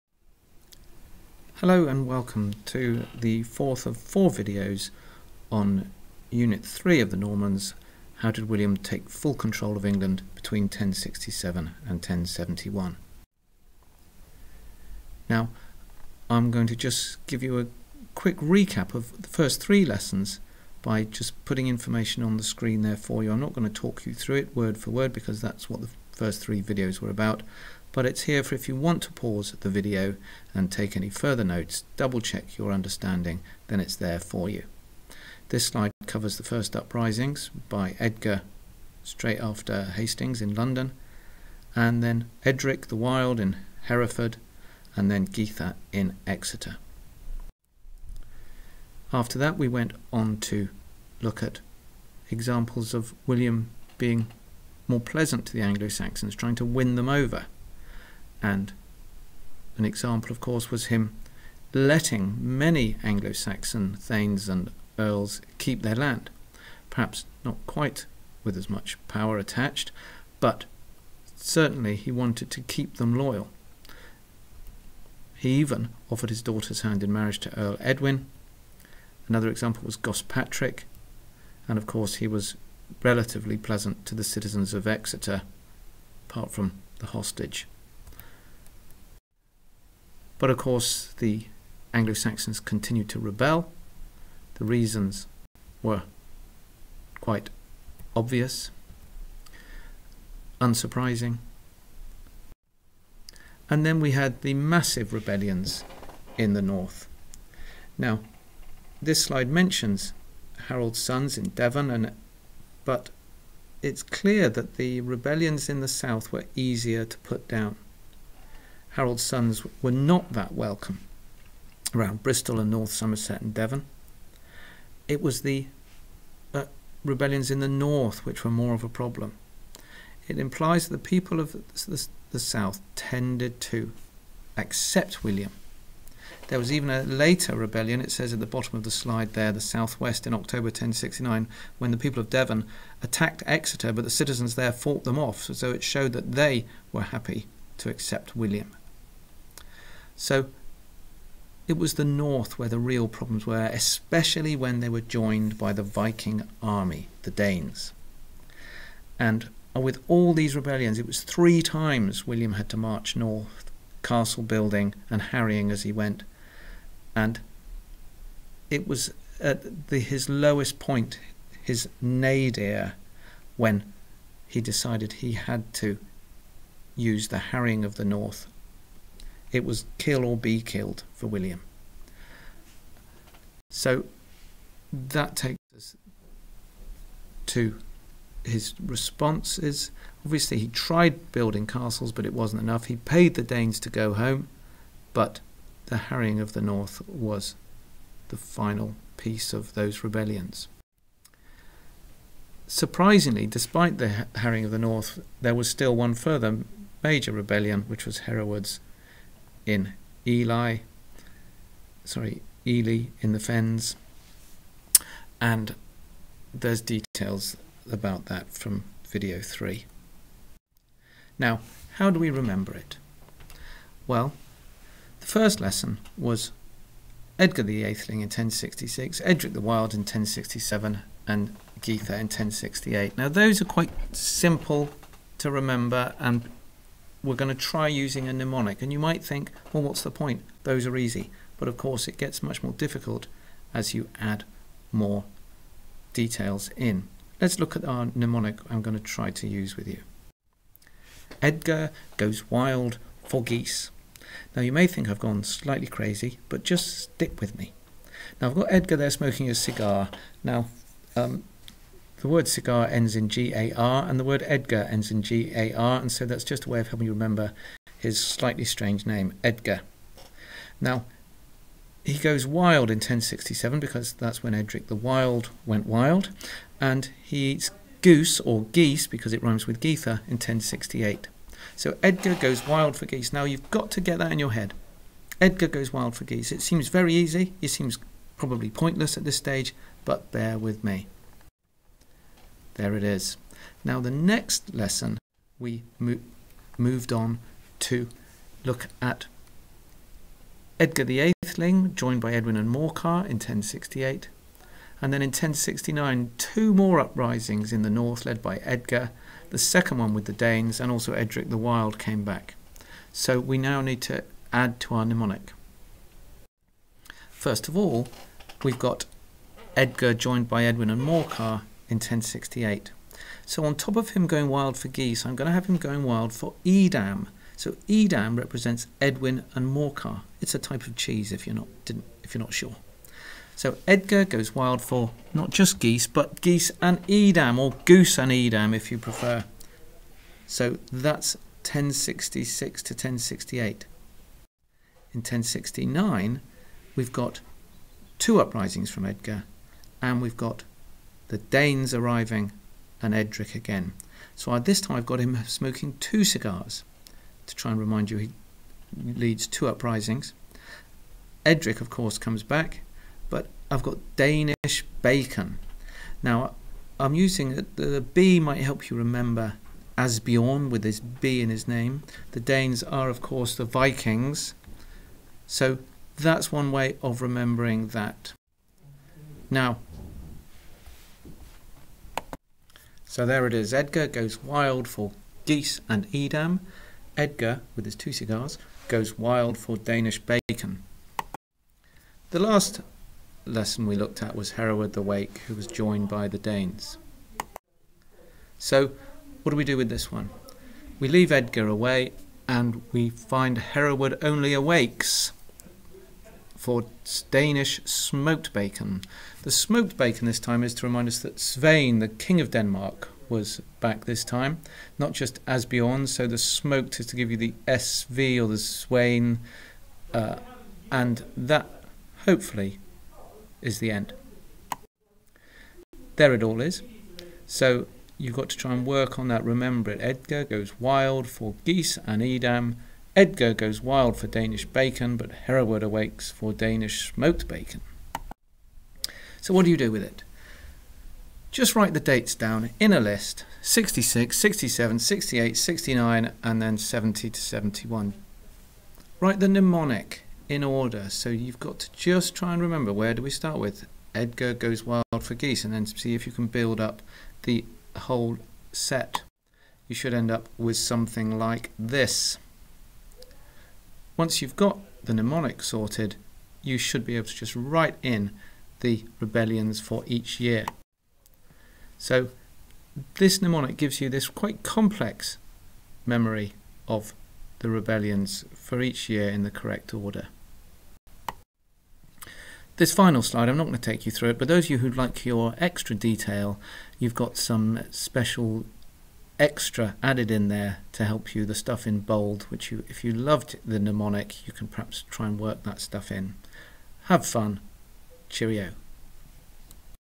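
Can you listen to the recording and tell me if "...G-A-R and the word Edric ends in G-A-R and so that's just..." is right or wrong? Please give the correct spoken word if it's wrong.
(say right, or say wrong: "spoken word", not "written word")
wrong: "Edgar", not "Edric".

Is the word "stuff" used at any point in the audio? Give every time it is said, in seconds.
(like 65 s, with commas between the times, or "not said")
491 s, 495 s.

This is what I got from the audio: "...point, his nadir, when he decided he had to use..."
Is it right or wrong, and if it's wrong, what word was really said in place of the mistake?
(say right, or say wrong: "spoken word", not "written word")
right.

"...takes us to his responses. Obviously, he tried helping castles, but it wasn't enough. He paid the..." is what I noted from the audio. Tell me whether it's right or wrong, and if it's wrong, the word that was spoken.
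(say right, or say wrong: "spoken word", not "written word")
wrong: "building", not "helping".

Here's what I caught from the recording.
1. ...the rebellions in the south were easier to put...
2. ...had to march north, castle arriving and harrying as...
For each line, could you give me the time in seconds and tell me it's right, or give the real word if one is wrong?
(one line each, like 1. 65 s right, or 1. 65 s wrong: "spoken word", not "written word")
1. 114 s right
2. 162 s wrong: "building", not "arriving".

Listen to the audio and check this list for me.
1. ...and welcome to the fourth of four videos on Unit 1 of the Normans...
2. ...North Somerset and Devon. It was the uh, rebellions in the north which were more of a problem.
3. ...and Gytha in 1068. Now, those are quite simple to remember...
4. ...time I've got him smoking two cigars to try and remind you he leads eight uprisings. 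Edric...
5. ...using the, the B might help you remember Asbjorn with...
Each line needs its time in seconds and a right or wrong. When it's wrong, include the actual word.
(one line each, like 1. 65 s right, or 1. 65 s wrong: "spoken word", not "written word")
1. 1 s wrong: "3", not "1"
2. 122 s right
3. 231 s right
4. 354 s wrong: "two", not "eight"
5. 367 s right.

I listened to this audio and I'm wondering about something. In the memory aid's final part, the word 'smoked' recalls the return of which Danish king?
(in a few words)
Svein.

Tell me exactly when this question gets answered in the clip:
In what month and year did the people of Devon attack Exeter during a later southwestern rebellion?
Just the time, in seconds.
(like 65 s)
140 s.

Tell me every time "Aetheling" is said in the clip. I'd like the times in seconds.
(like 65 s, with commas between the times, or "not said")
227 s, 301 s.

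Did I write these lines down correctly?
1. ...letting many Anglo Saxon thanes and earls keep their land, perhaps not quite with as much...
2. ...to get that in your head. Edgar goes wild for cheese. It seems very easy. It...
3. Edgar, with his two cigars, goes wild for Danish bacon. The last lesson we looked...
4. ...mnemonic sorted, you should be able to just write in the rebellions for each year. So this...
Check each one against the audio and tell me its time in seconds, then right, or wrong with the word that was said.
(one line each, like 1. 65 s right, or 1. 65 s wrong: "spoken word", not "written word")
1. 61 s right
2. 283 s wrong: "geese", not "cheese"
3. 387 s right
4. 465 s right.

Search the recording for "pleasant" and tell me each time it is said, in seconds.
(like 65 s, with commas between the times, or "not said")
55 s, 83 s.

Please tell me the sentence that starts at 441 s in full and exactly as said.
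Just write the dates down in a list 66, 67, 68, 69, and then 70 to 71.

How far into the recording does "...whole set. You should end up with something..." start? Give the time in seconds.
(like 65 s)
457 s.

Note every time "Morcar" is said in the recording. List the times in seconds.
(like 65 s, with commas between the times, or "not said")
302 s, 321 s, 329 s.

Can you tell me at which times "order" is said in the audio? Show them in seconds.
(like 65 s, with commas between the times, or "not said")
450 s, 479 s.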